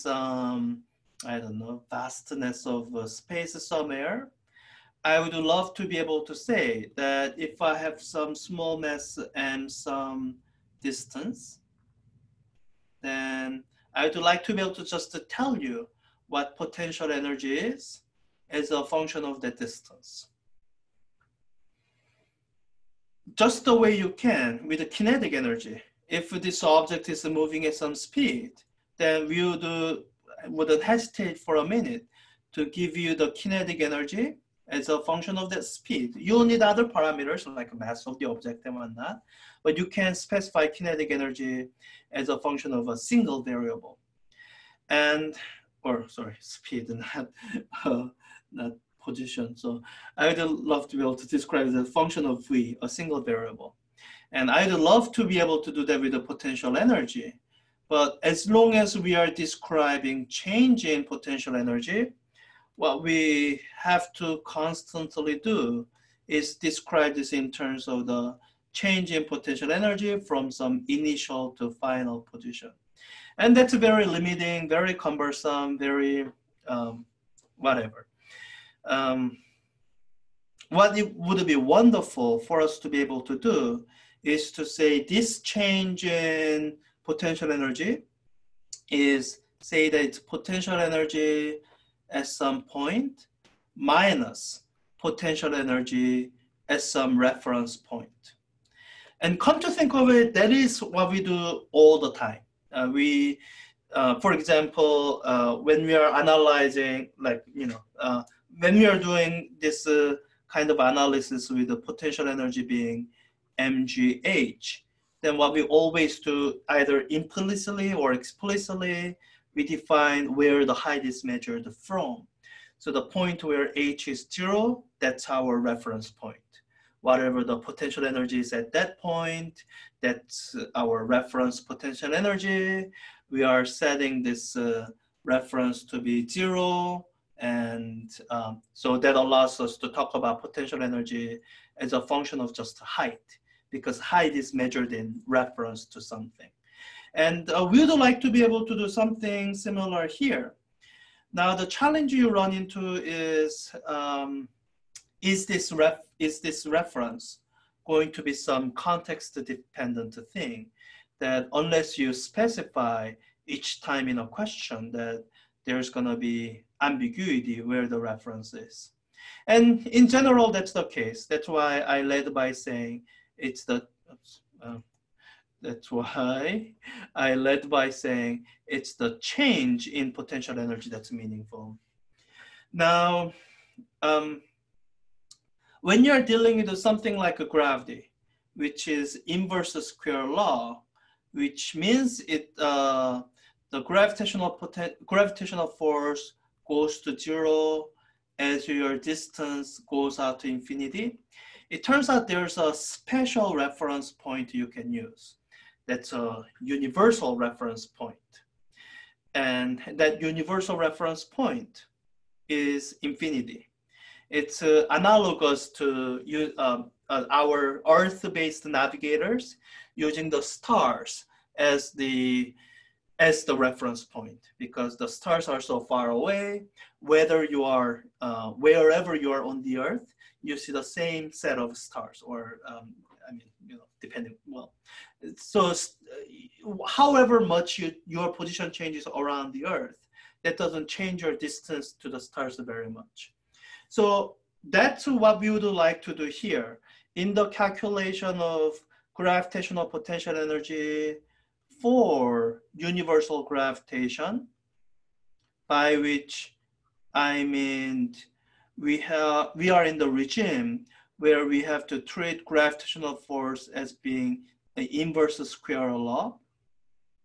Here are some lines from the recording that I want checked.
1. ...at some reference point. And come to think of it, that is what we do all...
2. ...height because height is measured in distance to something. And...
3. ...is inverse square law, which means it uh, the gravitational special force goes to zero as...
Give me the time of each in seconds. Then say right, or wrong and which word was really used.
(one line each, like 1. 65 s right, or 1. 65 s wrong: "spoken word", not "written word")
1. 96 s right
2. 142 s wrong: "reference", not "distance"
3. 188 s wrong: "gravitational", not "special".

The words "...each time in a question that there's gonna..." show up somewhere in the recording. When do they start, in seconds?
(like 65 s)
163 s.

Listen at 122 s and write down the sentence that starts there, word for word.
So the point where h is zero, that's our reference point.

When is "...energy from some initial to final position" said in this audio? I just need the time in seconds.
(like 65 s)
69 s.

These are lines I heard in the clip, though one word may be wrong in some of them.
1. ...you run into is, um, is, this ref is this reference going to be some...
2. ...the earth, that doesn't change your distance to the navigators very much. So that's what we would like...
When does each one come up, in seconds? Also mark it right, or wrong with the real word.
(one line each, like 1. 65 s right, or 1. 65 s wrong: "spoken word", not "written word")
1. 152 s right
2. 239 s wrong: "stars", not "navigators".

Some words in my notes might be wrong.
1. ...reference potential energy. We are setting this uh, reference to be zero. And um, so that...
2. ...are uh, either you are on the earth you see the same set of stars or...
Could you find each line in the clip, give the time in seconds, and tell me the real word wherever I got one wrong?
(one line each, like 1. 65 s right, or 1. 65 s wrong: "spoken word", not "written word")
1. 131 s right
2. 227 s wrong: "wherever", not "either".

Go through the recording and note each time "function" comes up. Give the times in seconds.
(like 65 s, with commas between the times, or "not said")
18 s, 35 s, 42 s, 51 s, 142 s.